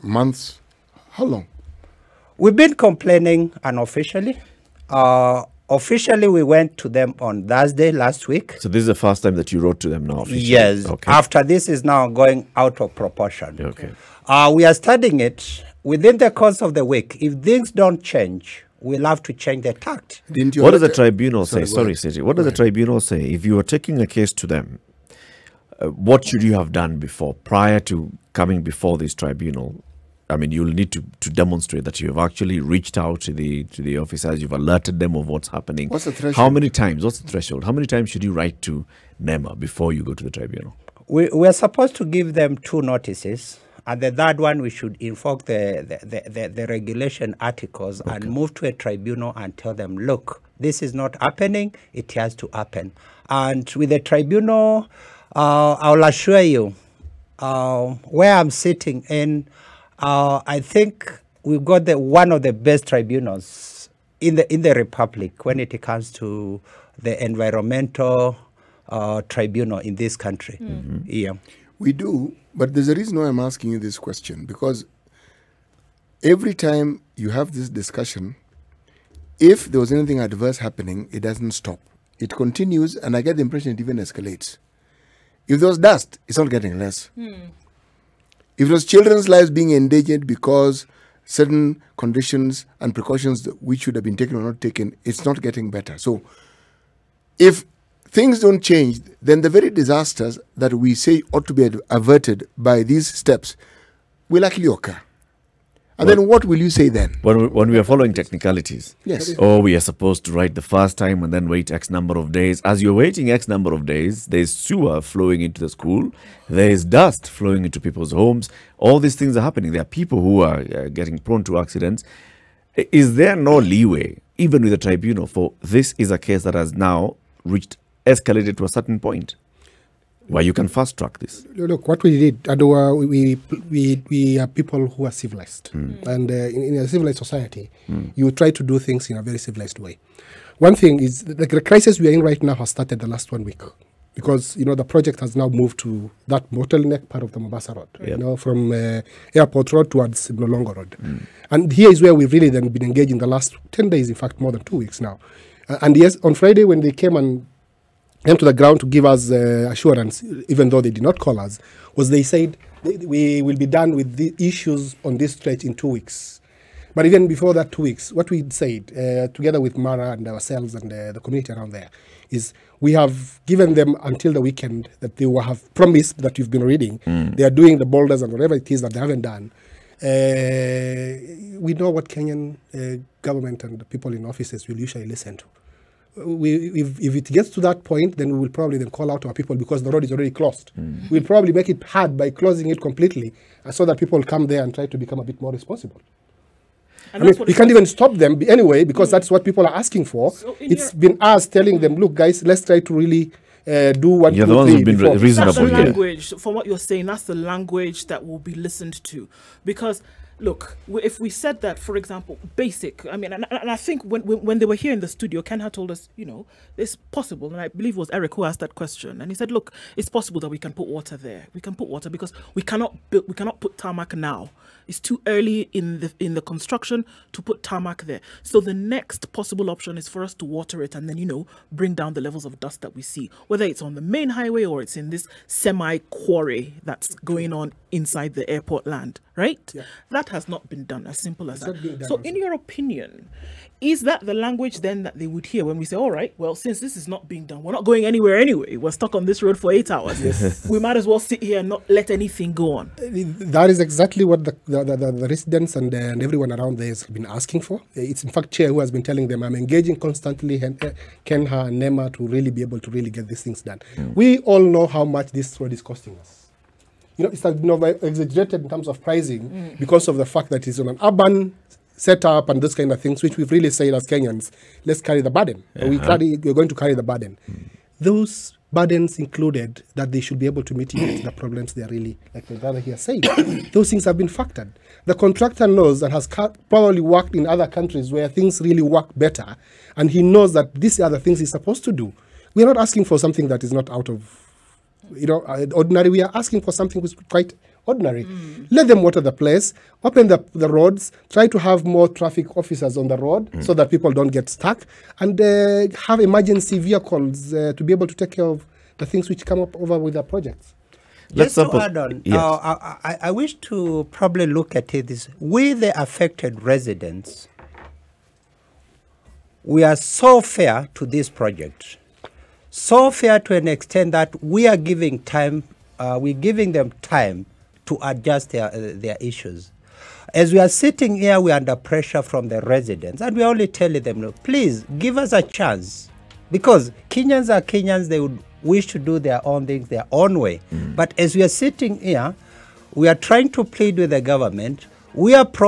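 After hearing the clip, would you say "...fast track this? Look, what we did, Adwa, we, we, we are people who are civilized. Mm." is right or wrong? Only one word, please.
right.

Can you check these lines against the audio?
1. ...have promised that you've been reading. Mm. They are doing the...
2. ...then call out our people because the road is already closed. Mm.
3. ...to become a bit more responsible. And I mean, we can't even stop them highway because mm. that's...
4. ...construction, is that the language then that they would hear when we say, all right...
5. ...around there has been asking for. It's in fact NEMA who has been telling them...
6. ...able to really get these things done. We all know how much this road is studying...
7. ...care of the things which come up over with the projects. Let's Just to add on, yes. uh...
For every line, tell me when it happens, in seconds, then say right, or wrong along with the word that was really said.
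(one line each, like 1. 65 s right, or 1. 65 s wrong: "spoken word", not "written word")
1. 175 s right
2. 188 s right
3. 194 s wrong: "anyway", not "highway"
4. 242 s wrong: "opinion", not "construction"
5. 256 s wrong: "Chair", not "NEMA"
6. 262 s wrong: "costing", not "studying"
7. 308 s right.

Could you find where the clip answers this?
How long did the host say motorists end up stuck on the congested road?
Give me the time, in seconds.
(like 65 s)
249 s.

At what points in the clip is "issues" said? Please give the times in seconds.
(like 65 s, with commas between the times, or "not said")
164 s, 329 s.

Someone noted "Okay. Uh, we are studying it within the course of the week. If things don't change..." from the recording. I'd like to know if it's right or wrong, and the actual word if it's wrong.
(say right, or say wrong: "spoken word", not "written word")
right.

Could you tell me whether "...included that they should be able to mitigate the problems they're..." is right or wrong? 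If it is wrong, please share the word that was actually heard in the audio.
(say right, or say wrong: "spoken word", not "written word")
right.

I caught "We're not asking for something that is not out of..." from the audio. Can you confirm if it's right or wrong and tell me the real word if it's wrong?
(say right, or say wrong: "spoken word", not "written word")
right.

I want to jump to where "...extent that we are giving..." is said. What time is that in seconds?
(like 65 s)
323 s.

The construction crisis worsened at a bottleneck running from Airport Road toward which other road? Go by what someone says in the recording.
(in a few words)
Mlolongo Road.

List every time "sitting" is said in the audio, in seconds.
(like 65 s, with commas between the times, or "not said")
58 s, 330 s, 341 s.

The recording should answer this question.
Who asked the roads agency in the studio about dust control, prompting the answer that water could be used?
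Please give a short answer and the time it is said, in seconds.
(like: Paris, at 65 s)
Eric, at 218 s.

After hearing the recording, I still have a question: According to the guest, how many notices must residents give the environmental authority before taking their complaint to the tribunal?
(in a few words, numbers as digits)
2.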